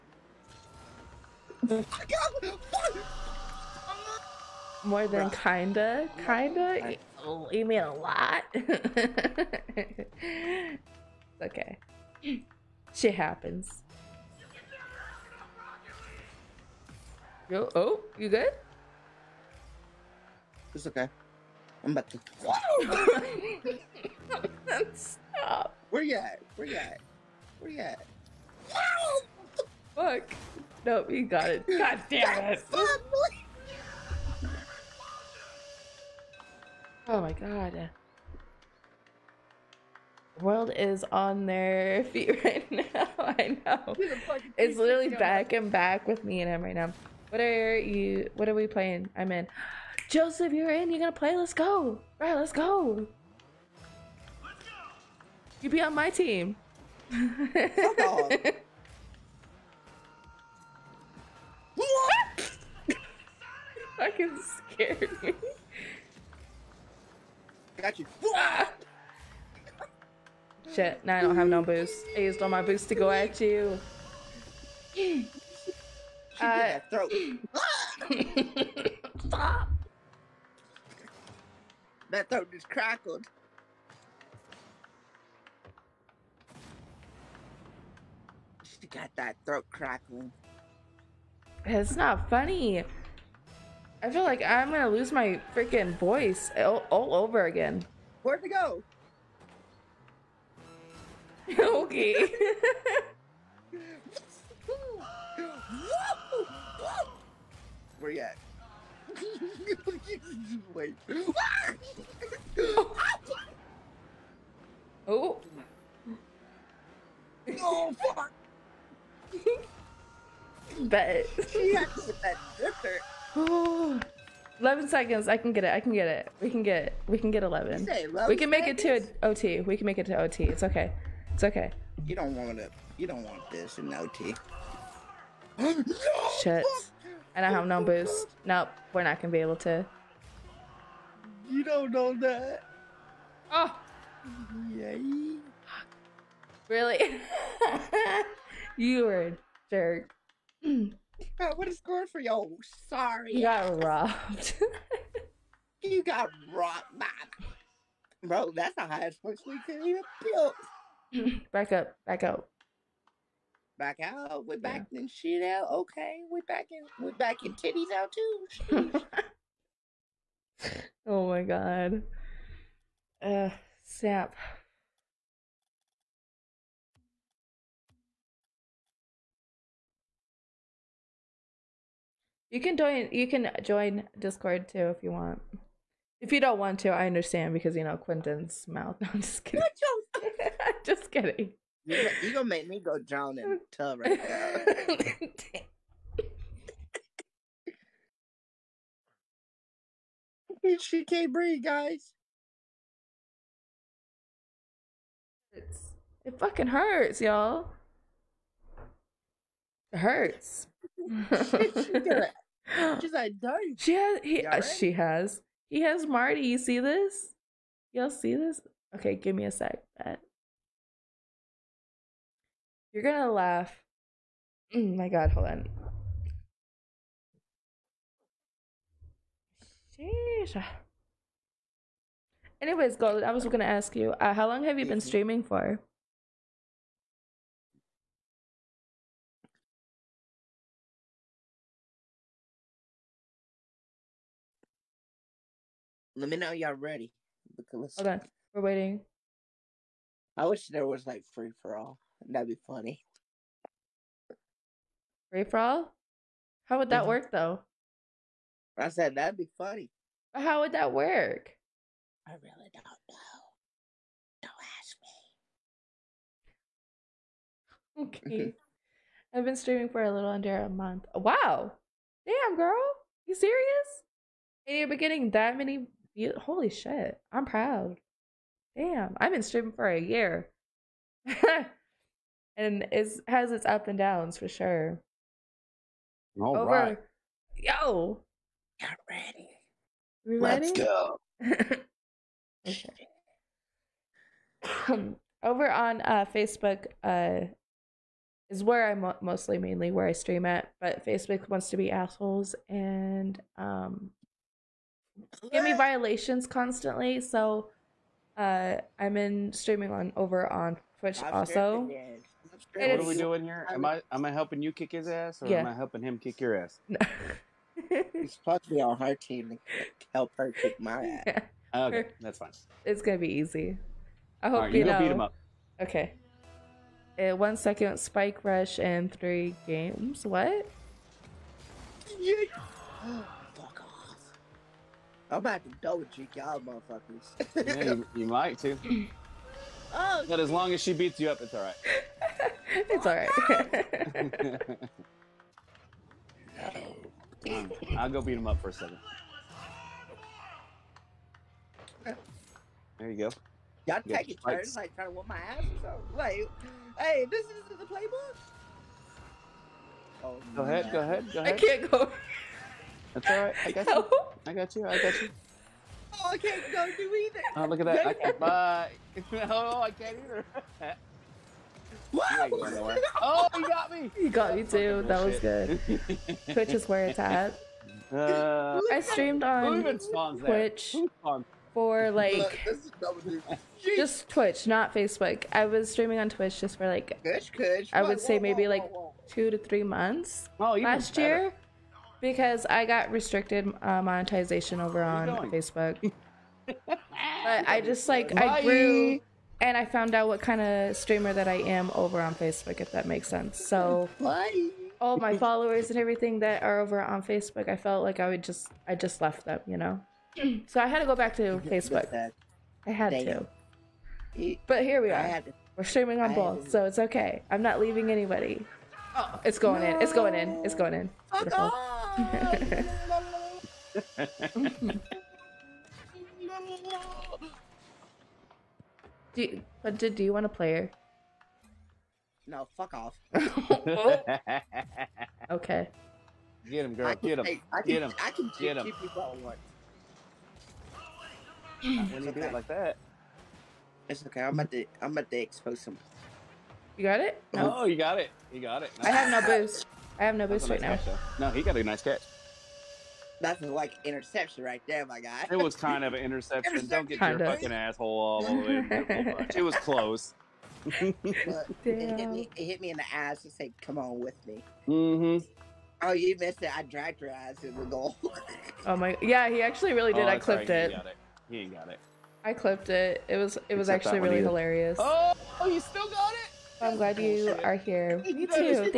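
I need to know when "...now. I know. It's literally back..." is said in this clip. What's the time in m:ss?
0:42.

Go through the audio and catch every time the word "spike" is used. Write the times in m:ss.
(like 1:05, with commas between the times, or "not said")
5:27.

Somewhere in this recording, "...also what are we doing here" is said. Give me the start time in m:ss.
5:11.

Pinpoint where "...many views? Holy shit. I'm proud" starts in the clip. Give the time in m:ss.
4:35.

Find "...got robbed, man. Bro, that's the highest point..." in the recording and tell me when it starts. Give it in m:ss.
2:36.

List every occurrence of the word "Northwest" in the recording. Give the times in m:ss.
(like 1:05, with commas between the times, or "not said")
not said.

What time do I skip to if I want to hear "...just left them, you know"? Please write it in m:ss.
6:48.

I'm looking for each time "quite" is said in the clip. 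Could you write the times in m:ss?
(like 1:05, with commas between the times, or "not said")
not said.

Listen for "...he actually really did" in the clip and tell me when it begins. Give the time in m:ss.
7:49.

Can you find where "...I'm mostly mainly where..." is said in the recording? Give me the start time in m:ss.
4:58.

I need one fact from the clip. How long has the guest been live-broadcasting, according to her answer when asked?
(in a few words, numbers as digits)
a little under a month.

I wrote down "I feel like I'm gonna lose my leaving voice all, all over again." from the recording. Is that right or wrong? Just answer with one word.
wrong.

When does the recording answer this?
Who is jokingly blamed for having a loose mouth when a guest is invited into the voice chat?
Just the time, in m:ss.
3:07.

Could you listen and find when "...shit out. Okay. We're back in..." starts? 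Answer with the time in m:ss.
2:45.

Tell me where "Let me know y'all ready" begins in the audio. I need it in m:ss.
4:06.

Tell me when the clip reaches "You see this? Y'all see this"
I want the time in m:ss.
3:36.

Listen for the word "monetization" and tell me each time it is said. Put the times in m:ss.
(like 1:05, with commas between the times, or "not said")
6:34.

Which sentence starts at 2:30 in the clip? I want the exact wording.
What a score for you Oh, Sorry.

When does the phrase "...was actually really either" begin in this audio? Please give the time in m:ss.
7:53.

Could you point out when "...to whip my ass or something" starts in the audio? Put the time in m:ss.
5:55.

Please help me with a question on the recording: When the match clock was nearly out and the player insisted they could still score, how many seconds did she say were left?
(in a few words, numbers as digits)
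11.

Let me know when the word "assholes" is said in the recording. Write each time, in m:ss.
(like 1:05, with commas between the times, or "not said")
5:01, 7:37.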